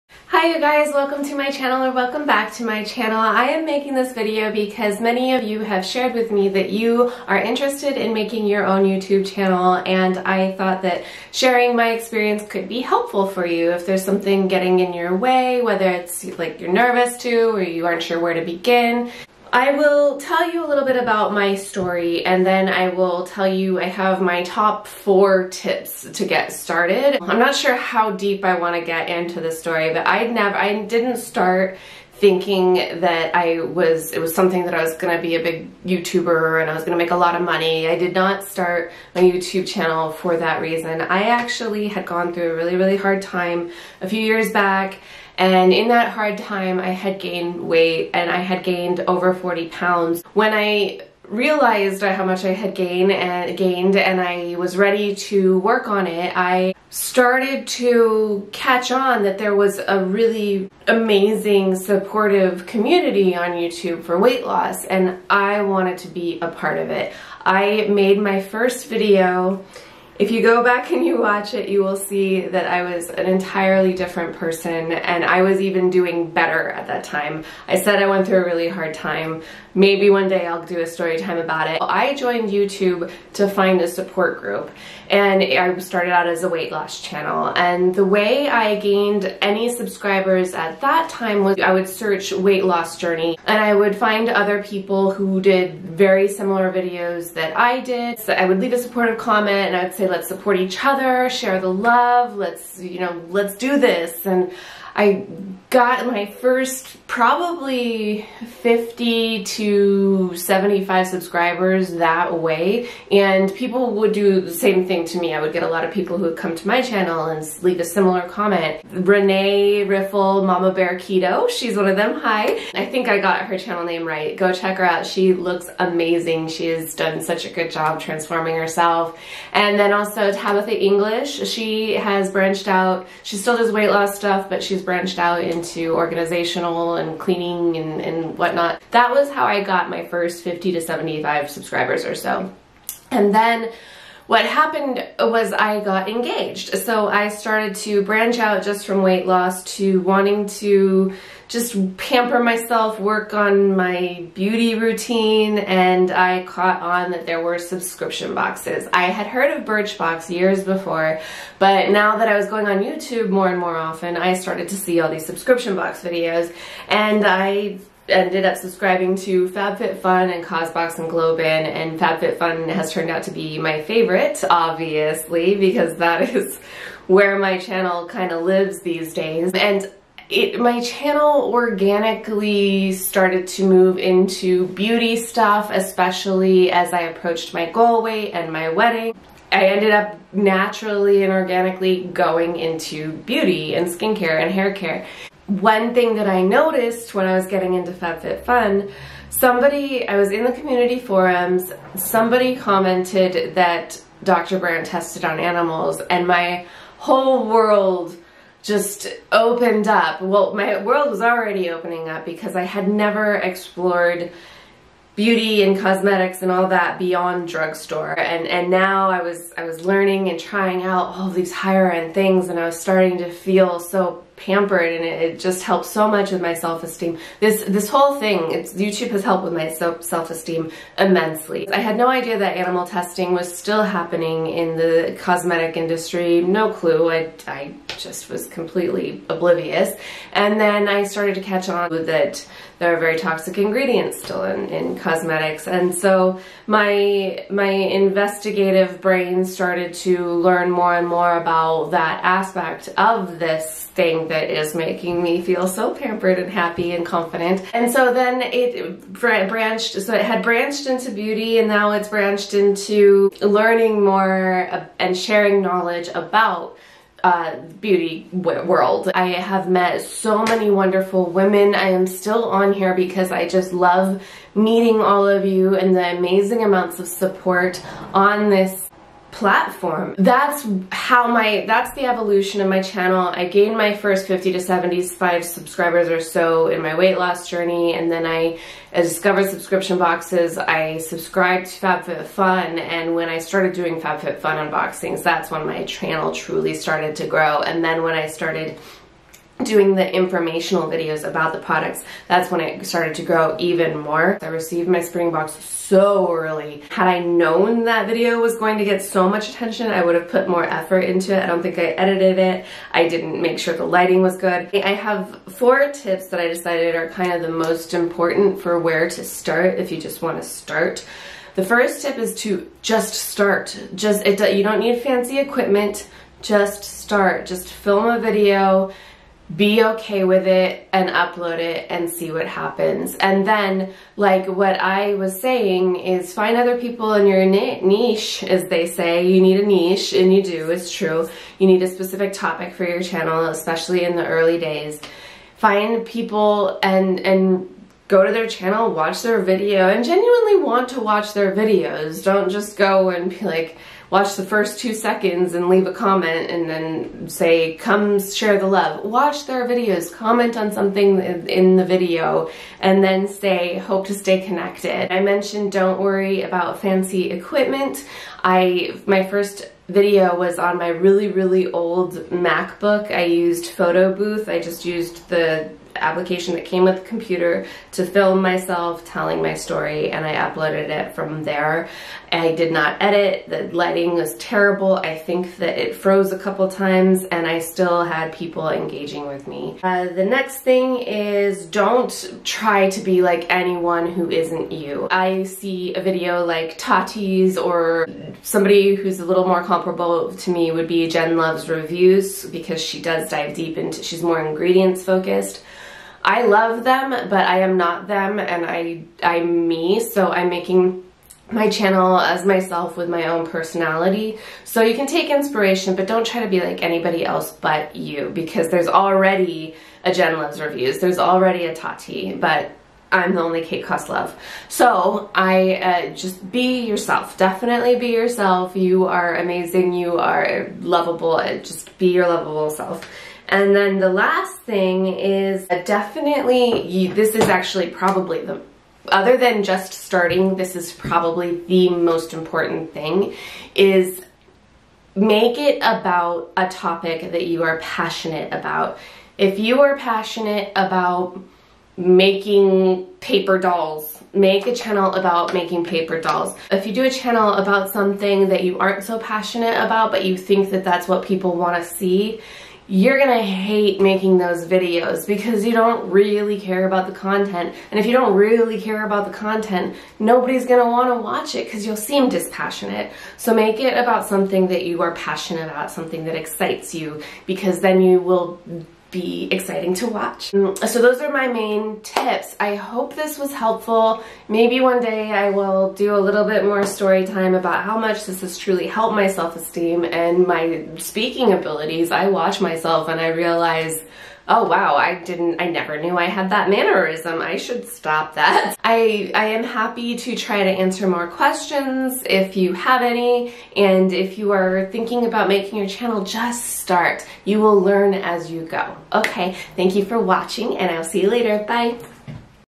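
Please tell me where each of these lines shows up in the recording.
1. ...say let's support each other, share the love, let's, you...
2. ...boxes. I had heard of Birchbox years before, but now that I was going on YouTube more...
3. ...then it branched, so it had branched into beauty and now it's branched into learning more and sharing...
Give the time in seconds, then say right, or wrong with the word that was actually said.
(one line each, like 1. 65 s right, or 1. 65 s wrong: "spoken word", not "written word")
1. 100 s right
2. 158 s right
3. 258 s right.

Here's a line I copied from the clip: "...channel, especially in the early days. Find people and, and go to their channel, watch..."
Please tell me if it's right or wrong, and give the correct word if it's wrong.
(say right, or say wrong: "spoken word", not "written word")
right.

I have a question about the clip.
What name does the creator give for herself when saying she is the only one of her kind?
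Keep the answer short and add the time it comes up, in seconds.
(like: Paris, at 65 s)
Kate Koslov, at 423 s.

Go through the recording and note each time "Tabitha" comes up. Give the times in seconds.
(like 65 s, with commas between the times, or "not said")
130 s.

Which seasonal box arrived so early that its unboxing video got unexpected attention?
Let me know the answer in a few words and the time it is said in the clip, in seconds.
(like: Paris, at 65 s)
spring box, at 305 s.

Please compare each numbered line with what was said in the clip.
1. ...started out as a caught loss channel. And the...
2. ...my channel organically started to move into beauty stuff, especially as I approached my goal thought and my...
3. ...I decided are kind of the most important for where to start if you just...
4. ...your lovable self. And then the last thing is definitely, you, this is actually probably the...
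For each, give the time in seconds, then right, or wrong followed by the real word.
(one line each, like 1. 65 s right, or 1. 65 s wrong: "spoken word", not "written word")
1. 85 s wrong: "weight", not "caught"
2. 180 s wrong: "weight", not "thought"
3. 316 s right
4. 432 s right.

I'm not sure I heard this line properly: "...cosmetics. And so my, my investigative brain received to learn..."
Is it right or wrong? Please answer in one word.
wrong.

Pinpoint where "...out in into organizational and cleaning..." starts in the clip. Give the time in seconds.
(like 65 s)
135 s.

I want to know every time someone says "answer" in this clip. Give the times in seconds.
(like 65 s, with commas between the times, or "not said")
500 s.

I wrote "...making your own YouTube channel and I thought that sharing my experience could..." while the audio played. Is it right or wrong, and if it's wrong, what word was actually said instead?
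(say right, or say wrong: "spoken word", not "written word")
right.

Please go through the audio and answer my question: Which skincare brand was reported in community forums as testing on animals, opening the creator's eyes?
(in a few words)
Dr. Brandt.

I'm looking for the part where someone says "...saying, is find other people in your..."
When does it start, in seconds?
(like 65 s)
335 s.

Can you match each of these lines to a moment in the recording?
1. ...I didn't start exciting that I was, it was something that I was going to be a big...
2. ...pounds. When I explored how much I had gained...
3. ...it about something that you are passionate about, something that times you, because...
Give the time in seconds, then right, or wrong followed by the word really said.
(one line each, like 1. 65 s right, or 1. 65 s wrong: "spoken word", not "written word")
1. 30 s wrong: "thinking", not "exciting"
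2. 49 s wrong: "realized", not "explored"
3. 473 s wrong: "excites", not "times".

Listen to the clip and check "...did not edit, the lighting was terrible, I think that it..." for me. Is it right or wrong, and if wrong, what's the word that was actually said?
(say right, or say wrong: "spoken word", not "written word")
right.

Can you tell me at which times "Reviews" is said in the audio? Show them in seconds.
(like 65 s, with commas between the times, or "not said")
401 s, 420 s.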